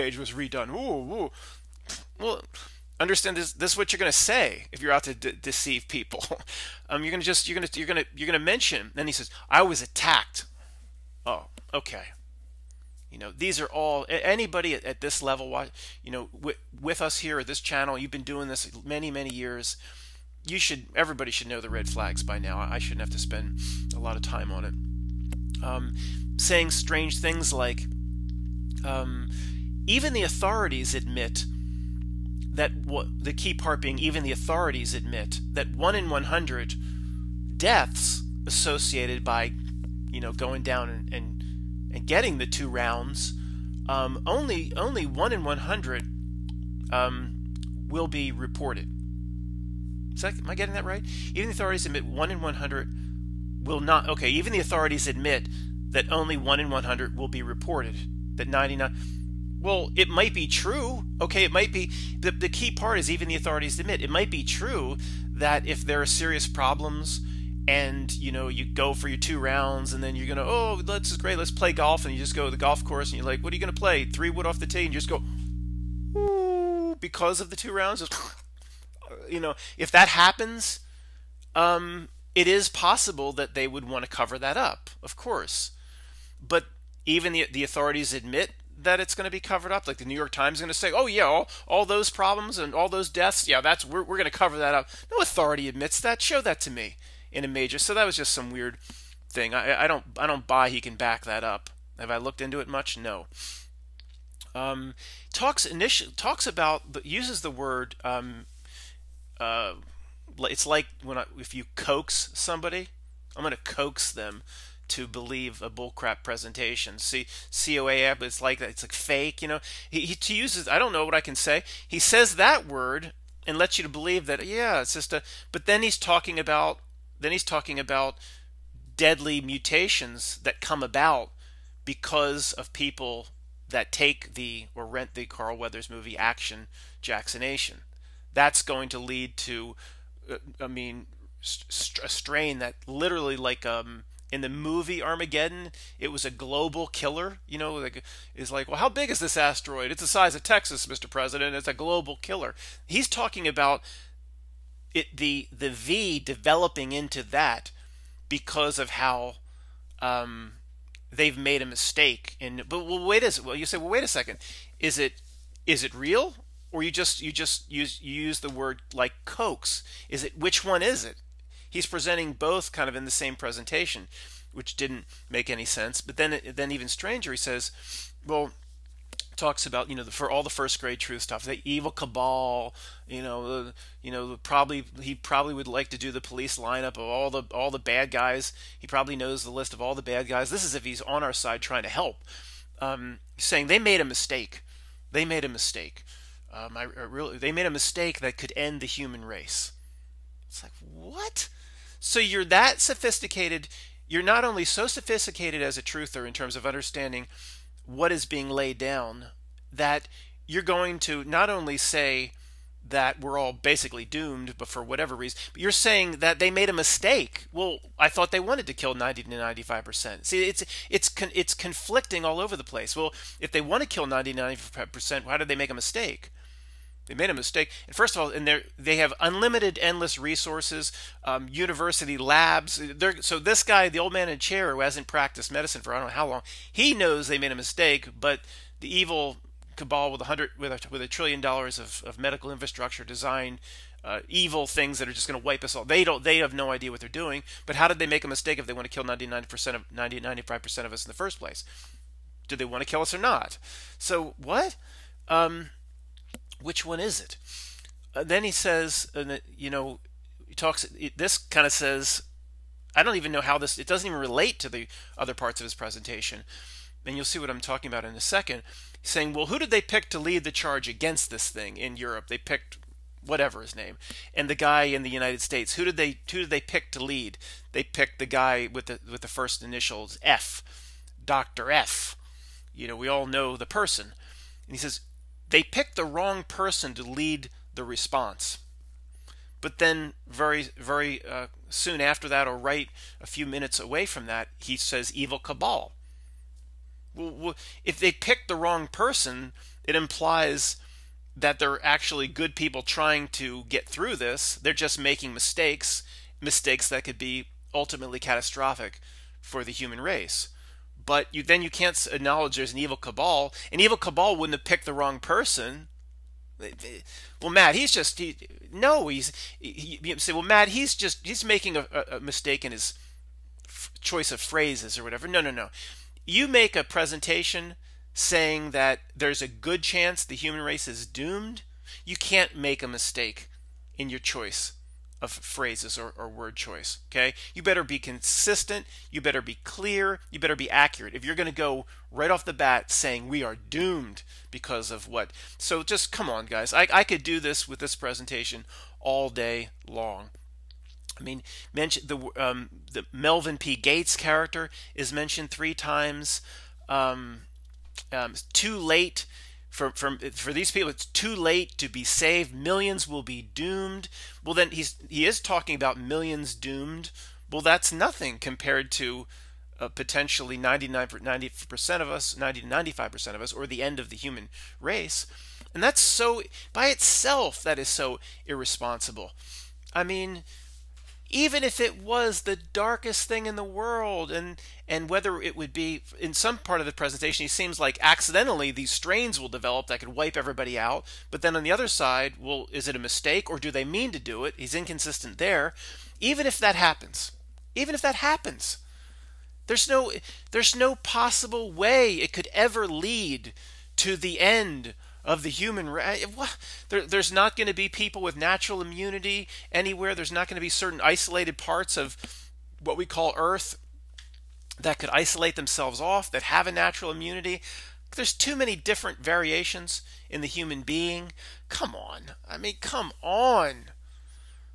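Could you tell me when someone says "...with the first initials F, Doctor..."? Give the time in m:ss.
4:39.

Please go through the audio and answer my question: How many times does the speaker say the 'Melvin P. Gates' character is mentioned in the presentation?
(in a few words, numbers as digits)
3.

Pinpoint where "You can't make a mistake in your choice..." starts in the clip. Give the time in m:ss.
5:32.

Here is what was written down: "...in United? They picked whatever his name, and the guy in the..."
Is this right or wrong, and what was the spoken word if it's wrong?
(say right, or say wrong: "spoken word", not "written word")
wrong: "Europe", not "United".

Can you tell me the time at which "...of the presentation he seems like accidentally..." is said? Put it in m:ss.
6:26.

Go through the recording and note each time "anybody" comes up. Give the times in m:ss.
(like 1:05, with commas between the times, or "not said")
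0:14.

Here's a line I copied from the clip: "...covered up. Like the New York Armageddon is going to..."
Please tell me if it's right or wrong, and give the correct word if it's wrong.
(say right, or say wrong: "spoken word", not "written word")
wrong: "Times", not "Armageddon".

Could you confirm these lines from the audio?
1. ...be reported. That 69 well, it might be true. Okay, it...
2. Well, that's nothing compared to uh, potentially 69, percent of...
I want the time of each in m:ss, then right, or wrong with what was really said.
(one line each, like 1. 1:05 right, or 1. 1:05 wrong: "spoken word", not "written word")
1. 0:57 wrong: "99", not "69"
2. 6:07 wrong: "99", not "69".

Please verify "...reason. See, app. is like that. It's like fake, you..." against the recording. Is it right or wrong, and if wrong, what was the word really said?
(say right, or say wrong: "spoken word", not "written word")
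wrong: "presentation", not "reason".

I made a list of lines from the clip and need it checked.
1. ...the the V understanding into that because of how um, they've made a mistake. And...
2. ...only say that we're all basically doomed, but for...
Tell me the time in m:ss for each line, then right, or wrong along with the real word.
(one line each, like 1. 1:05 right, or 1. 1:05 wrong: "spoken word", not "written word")
1. 2:35 wrong: "developing", not "understanding"
2. 3:31 right.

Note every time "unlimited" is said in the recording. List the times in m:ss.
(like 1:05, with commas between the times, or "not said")
3:49.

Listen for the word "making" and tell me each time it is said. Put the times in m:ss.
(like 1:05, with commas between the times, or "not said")
5:04, 5:21.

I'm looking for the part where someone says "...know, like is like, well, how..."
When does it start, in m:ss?
2:27.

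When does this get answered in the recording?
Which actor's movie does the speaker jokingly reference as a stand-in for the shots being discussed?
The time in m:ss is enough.
2:15.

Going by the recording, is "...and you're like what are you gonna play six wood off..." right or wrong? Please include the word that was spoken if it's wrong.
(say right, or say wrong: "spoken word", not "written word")
wrong: "three", not "six".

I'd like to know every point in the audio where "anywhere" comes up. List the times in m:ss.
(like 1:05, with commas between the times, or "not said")
6:49.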